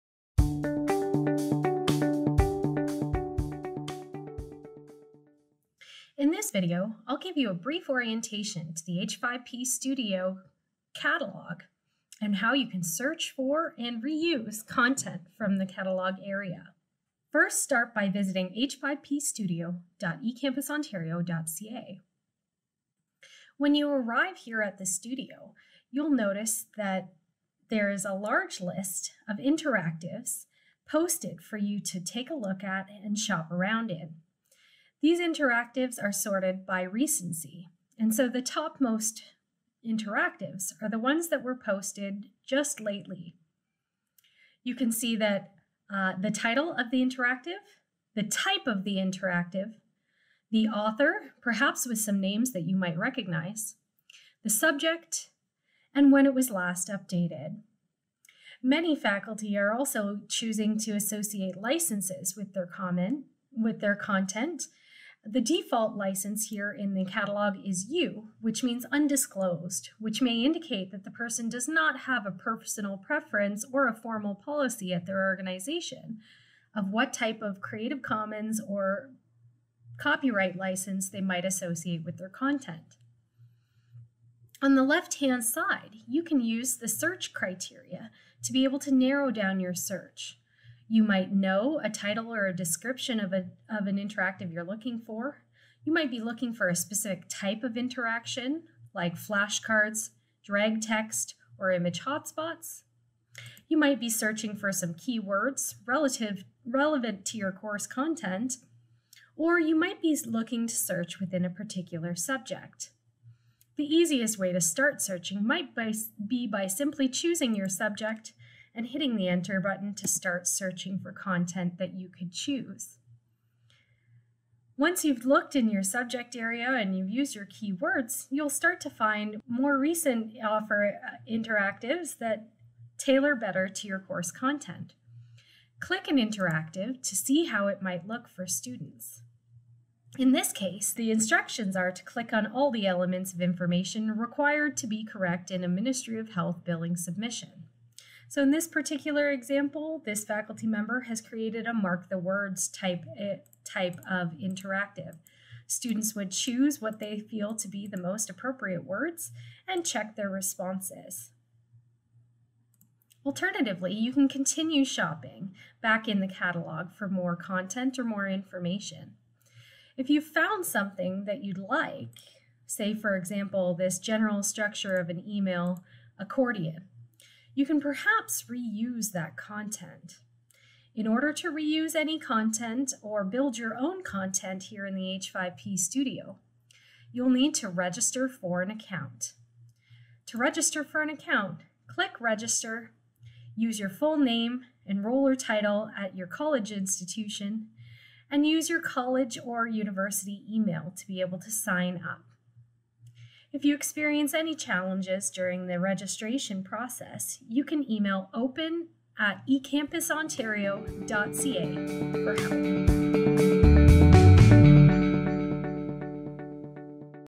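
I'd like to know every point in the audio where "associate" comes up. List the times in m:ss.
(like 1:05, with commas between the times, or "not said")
1:00, 1:21.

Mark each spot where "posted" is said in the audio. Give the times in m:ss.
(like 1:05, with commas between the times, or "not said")
0:30, 0:41.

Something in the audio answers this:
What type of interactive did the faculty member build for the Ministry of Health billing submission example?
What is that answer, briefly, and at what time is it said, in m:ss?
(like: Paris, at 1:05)
Mark the words, at 2:31.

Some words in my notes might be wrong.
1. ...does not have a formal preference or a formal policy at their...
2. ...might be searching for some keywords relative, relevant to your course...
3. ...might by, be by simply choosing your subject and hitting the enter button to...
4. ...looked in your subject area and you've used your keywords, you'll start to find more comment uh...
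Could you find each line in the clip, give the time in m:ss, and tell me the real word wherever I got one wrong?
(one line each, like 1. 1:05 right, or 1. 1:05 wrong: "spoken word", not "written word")
1. 1:11 wrong: "personal", not "formal"
2. 1:43 right
3. 1:55 right
4. 2:05 wrong: "recent", not "comment".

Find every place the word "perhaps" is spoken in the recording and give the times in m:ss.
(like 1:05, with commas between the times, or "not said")
0:51, 2:57.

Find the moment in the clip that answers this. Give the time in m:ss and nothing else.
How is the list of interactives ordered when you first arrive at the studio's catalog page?
0:36.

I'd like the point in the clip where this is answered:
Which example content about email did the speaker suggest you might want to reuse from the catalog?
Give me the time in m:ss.
2:56.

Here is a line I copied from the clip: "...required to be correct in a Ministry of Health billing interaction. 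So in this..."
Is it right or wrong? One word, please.
wrong.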